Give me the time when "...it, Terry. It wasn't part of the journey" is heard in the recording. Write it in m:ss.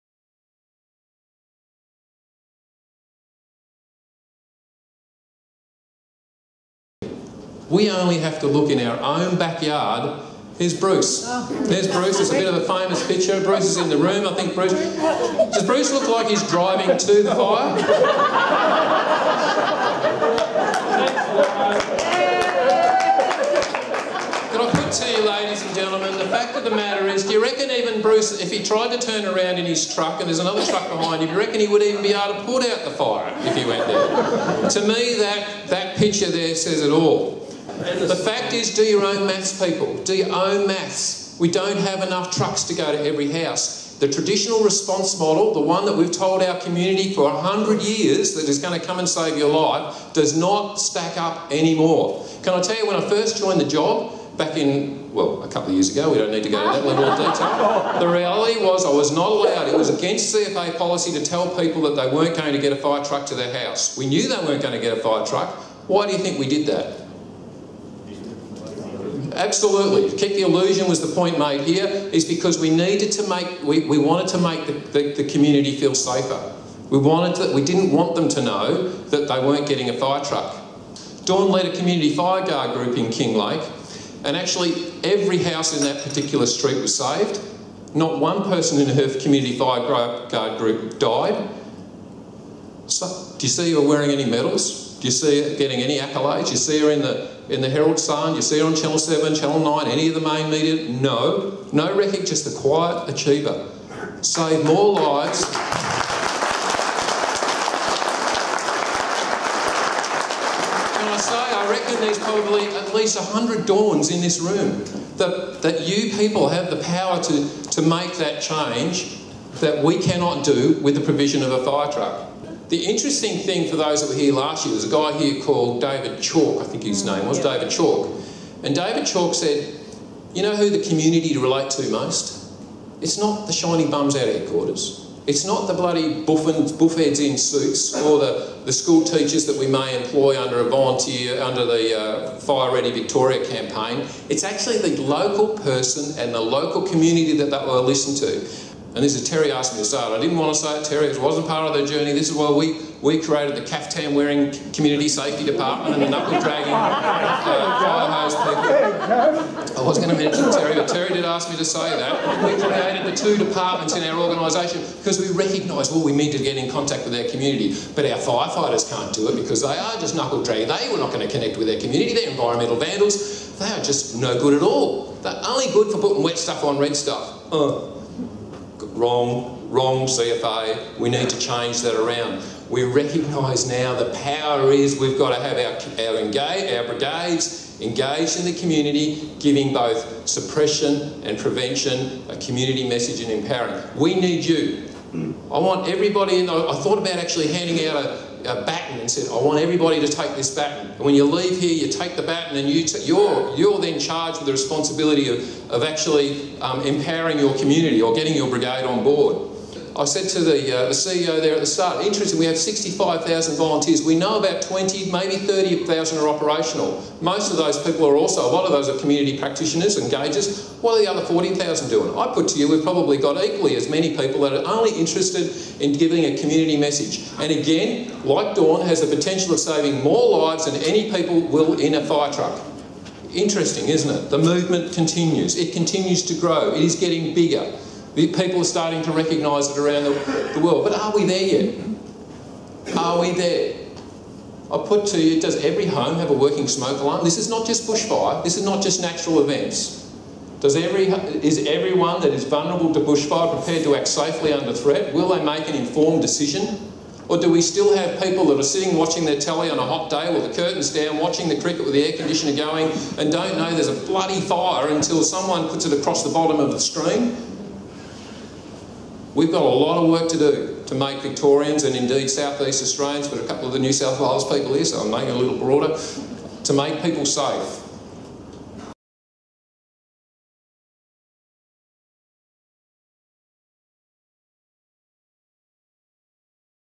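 2:30.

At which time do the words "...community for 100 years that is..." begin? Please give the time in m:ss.
0:46.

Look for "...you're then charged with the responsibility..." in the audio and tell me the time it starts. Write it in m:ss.
3:23.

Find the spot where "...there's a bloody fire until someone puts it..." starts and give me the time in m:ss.
4:23.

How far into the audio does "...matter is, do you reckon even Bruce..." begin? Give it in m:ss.
0:26.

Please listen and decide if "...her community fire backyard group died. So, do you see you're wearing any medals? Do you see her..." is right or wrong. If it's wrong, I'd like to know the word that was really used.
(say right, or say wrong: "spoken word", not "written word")
wrong: "guard", not "backyard".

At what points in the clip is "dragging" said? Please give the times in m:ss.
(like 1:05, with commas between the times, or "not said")
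2:36, 2:50.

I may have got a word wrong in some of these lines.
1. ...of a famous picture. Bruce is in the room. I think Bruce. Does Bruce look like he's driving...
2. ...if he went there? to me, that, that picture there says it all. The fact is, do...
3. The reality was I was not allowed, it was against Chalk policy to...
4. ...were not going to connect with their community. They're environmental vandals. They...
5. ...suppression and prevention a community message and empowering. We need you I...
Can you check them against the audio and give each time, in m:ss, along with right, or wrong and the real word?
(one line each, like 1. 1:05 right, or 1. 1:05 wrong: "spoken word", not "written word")
1. 0:12 right
2. 0:33 right
3. 0:57 wrong: "CFA", not "Chalk"
4. 2:50 right
5. 3:10 right.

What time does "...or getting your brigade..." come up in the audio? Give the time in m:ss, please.
3:28.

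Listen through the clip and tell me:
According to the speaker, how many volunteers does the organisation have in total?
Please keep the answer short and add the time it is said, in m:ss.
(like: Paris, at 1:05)
65,000, at 3:32.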